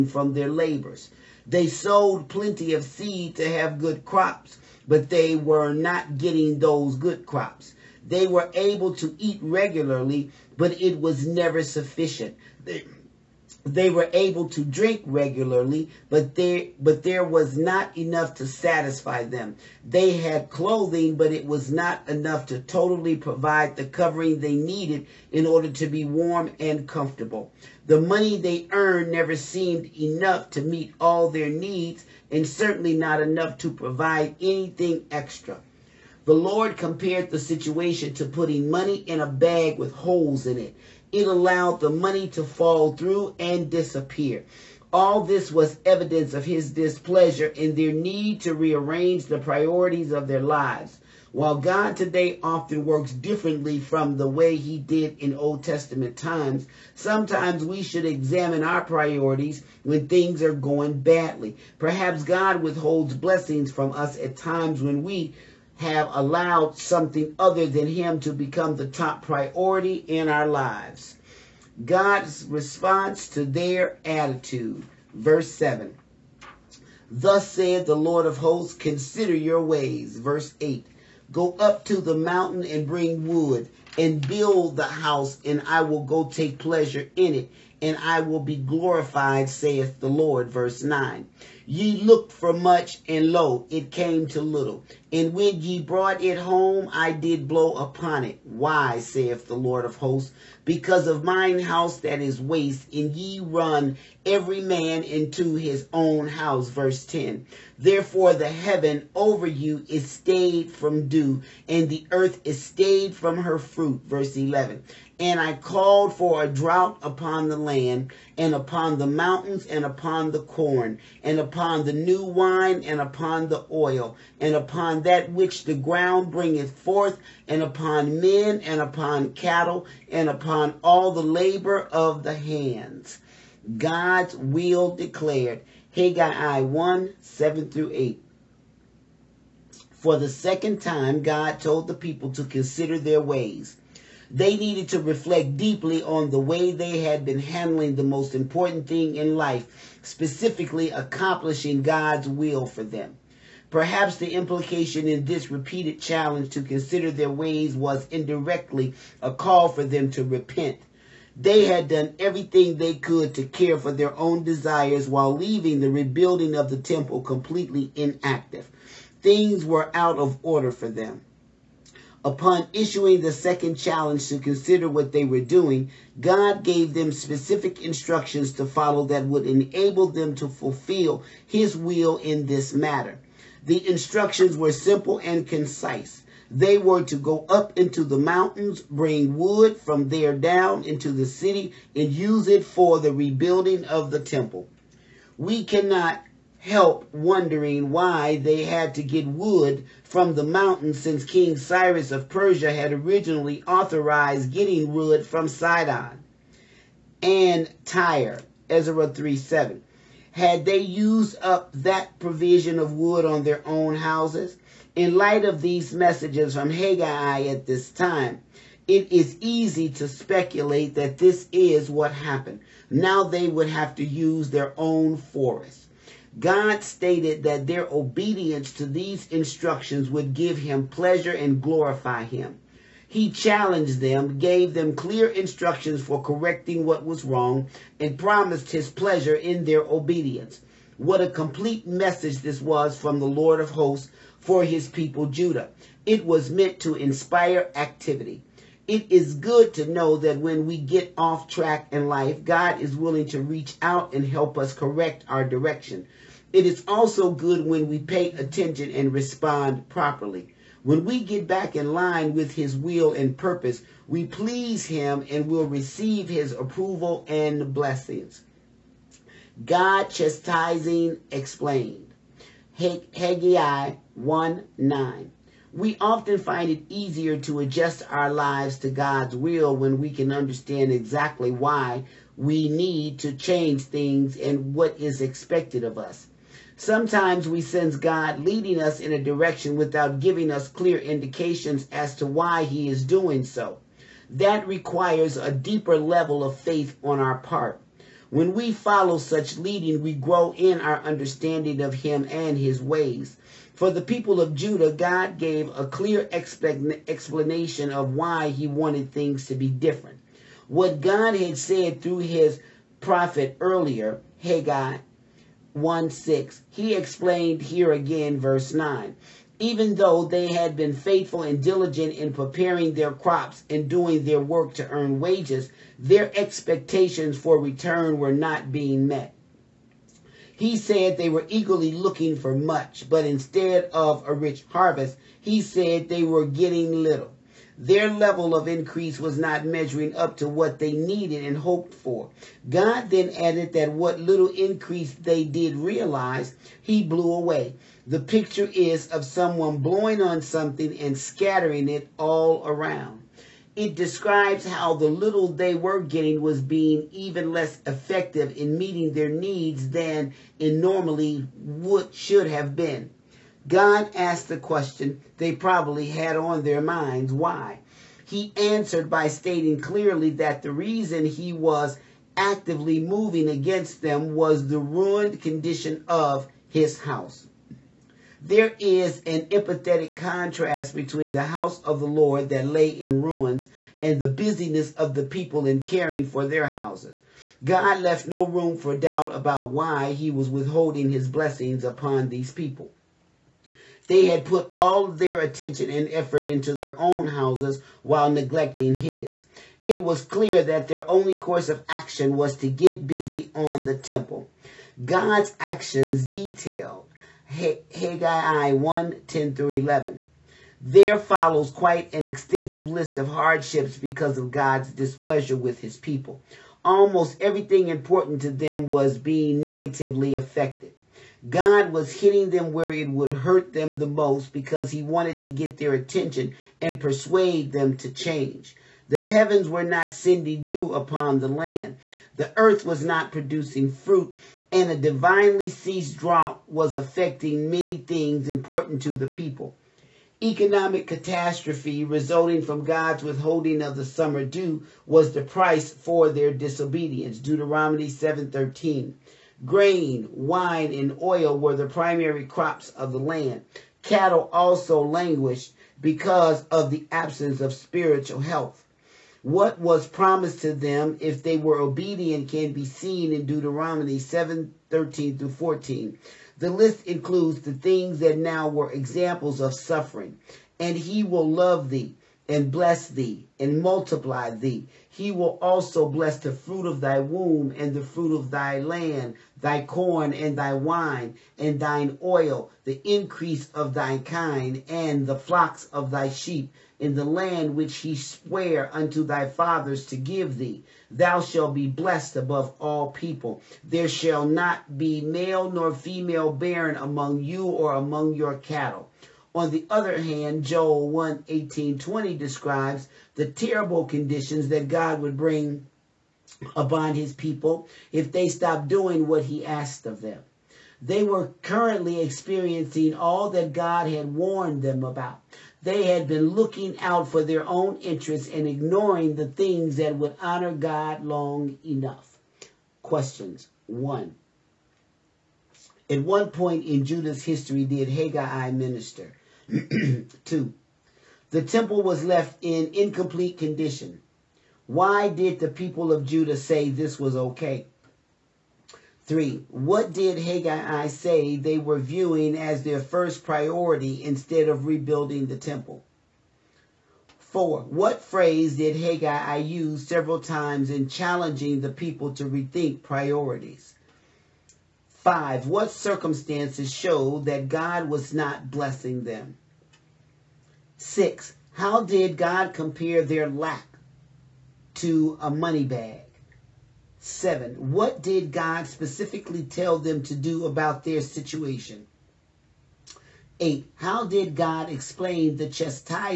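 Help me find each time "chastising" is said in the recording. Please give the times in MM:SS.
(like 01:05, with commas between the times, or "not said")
04:30, 09:35.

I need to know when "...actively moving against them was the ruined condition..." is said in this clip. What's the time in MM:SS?
06:12.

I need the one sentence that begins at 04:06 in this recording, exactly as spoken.
It was meant to inspire activity.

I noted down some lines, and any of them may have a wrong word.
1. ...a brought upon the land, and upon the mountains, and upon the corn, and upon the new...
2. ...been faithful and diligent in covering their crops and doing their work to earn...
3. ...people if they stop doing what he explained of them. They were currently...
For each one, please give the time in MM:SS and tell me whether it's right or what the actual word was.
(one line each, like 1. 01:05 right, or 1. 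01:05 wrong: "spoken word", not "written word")
1. 01:56 wrong: "drought", not "brought"
2. 05:20 wrong: "preparing", not "covering"
3. 08:27 wrong: "asked", not "explained".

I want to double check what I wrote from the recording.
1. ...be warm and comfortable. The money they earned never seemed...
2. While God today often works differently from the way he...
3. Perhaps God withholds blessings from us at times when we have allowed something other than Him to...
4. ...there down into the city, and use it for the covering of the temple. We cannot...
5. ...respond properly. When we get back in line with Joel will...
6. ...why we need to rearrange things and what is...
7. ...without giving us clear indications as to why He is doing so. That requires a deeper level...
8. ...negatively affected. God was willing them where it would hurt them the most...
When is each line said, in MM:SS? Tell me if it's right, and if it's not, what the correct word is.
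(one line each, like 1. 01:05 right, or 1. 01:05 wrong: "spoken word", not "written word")
1. 00:25 right
2. 00:51 right
3. 01:01 right
4. 03:10 wrong: "rebuilding", not "covering"
5. 04:19 wrong: "His", not "Joel"
6. 04:41 wrong: "change", not "rearrange"
7. 04:49 right
8. 06:59 wrong: "hitting", not "willing".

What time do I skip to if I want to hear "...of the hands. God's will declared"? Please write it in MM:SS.
02:11.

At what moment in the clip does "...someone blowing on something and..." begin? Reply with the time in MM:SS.
05:49.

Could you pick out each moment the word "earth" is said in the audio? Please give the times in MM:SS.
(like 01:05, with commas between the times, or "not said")
01:52, 07:12.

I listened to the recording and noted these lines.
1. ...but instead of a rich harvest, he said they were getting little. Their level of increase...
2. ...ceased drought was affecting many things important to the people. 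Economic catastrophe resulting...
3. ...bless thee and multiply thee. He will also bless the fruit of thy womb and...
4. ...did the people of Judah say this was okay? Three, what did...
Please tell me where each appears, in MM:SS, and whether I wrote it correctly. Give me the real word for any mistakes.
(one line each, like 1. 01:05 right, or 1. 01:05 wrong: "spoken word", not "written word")
1. 05:33 right
2. 07:15 right
3. 07:52 right
4. 08:55 right.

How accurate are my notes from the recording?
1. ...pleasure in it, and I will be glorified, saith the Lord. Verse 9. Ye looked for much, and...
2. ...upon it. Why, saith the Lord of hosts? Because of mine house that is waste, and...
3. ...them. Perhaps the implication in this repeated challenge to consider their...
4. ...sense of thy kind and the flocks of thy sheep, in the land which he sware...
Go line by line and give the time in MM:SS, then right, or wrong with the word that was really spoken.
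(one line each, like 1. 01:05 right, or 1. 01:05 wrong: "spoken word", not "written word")
1. 01:26 right
2. 01:37 right
3. 02:32 right
4. 08:03 wrong: "increase", not "sense".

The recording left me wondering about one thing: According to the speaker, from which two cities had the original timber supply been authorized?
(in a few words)
Sidon and Tyre.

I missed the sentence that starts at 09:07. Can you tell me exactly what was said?
Four, what phrase did Haggai use several times in challenging the people to rethink priorities?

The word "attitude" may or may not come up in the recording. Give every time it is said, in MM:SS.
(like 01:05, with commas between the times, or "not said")
01:14.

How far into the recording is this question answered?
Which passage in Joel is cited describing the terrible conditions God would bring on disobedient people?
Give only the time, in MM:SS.
08:20.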